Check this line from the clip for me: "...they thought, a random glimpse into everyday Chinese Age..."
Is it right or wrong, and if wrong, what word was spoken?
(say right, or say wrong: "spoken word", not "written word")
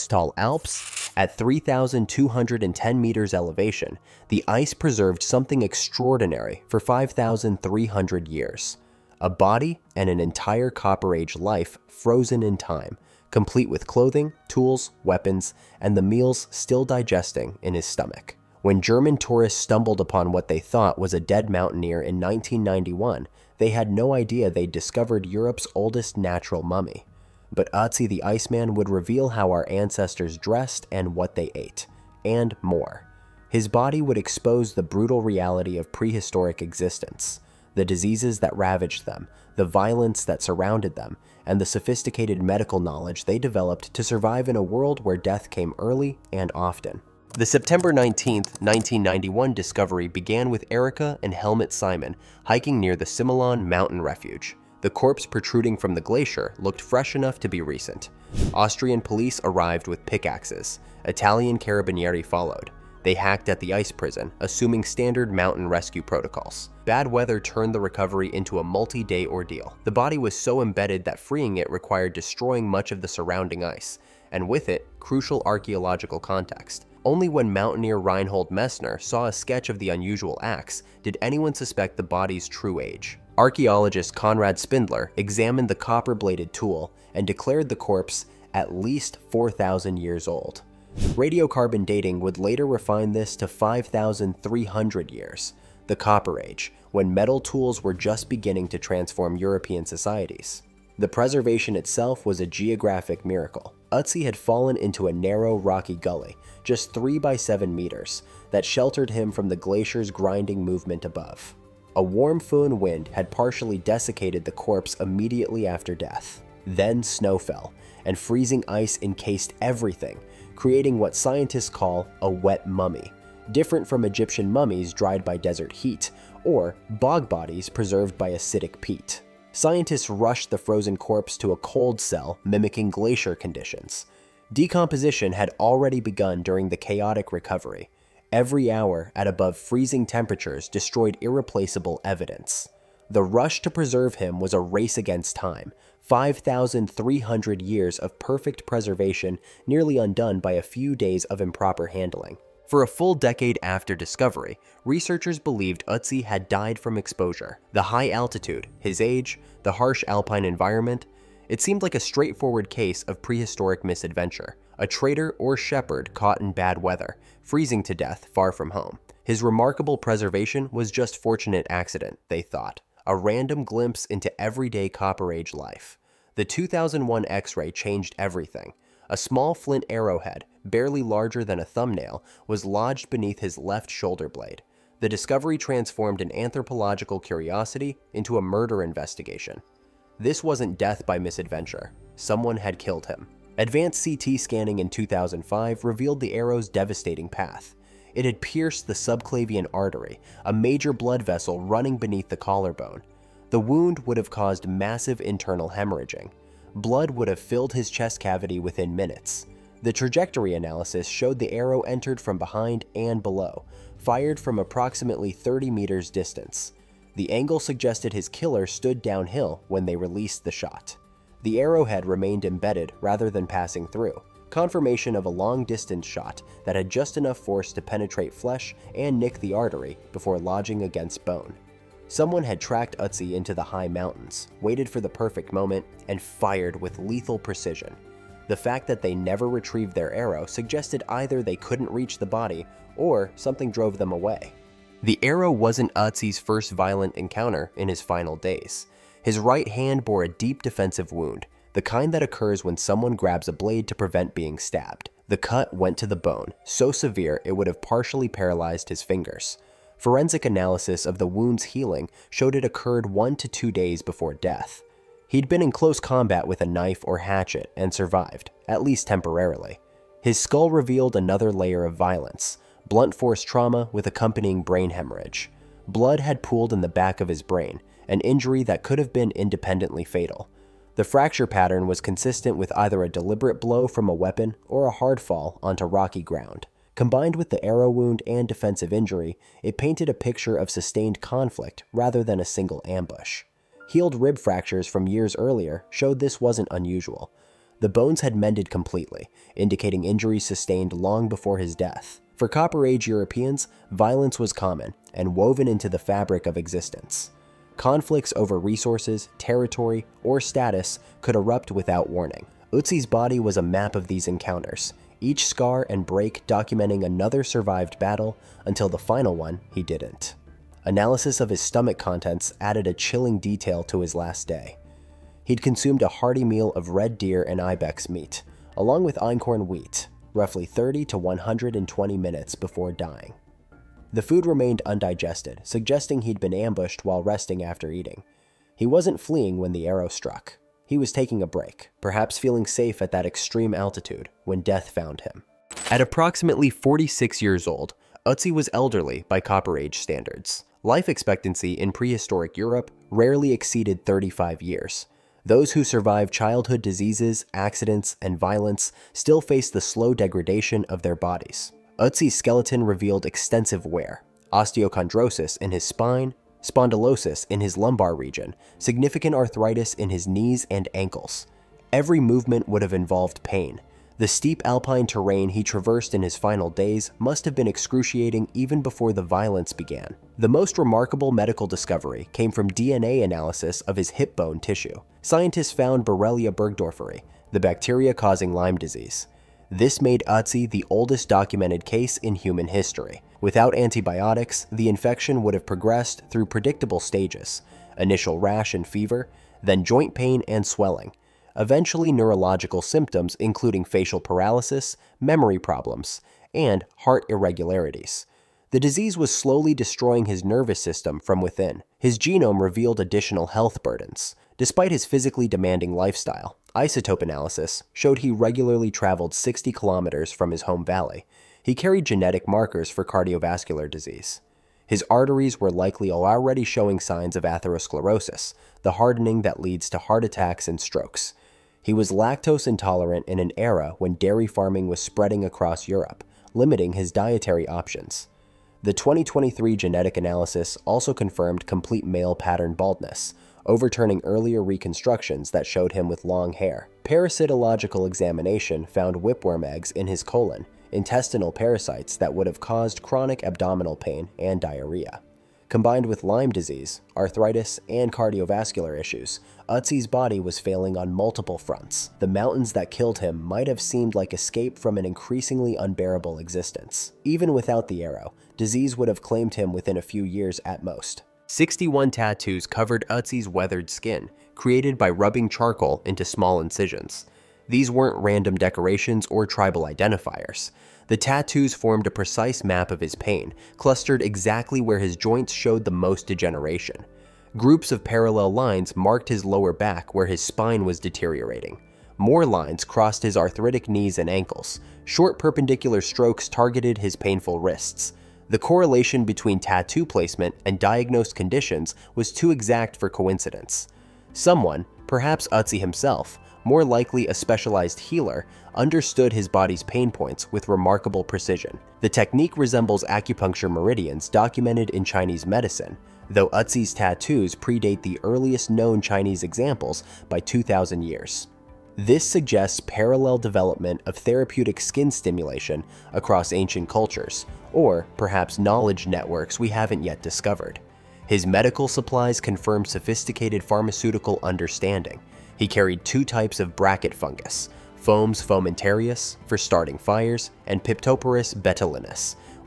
wrong: "Copper", not "Chinese".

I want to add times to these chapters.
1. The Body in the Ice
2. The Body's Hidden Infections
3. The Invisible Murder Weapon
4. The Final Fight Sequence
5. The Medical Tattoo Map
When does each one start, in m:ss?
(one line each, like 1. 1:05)
1. 0:47
2. 5:45
3. 2:32
4. 4:05
5. 7:51.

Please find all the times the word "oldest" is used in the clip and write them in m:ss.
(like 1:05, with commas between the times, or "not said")
0:25, 6:30.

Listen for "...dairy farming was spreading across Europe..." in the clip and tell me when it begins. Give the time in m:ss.
7:14.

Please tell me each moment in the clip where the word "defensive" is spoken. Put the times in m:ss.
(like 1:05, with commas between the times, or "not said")
4:10, 4:48.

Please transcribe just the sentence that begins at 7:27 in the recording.
Parasitological examination found whipworm eggs in his colon, intestinal parasites that would have caused chronic abdominal pain and diarrhea.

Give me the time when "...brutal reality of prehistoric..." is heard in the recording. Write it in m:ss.
0:34.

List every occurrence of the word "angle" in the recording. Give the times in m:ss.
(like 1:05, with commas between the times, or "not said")
3:37.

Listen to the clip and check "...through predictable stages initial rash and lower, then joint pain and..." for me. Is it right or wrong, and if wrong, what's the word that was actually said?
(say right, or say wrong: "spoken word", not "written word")
wrong: "fever", not "lower".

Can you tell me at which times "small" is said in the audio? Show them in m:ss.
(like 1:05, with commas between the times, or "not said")
2:59, 7:56.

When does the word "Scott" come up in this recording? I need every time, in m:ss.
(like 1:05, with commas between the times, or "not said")
not said.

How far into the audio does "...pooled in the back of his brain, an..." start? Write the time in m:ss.
4:36.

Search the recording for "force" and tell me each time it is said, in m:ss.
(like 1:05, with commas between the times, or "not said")
3:47, 4:33.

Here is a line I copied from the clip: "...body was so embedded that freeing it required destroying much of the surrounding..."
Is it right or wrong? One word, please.
right.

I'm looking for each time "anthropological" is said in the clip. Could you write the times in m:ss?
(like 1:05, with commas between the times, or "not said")
3:06.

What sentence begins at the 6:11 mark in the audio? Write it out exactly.
Every movement would have involved pain.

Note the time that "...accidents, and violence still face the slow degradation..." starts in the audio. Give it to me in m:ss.
5:57.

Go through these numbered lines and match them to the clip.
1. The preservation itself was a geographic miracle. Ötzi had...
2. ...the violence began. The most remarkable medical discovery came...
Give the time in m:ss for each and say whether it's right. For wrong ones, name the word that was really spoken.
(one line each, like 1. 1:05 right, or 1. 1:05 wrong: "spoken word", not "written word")
1. 1:40 right
2. 6:19 right.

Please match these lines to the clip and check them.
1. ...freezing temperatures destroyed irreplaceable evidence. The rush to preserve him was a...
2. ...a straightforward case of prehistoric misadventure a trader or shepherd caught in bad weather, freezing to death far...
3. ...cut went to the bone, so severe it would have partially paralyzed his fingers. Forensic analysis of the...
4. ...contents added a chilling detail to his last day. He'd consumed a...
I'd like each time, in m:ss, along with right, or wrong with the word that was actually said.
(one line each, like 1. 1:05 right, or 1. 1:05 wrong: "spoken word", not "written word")
1. 2:19 right
2. 2:41 right
3. 4:15 right
4. 5:21 right.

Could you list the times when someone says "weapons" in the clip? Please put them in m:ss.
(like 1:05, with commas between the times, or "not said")
0:15, 4:44.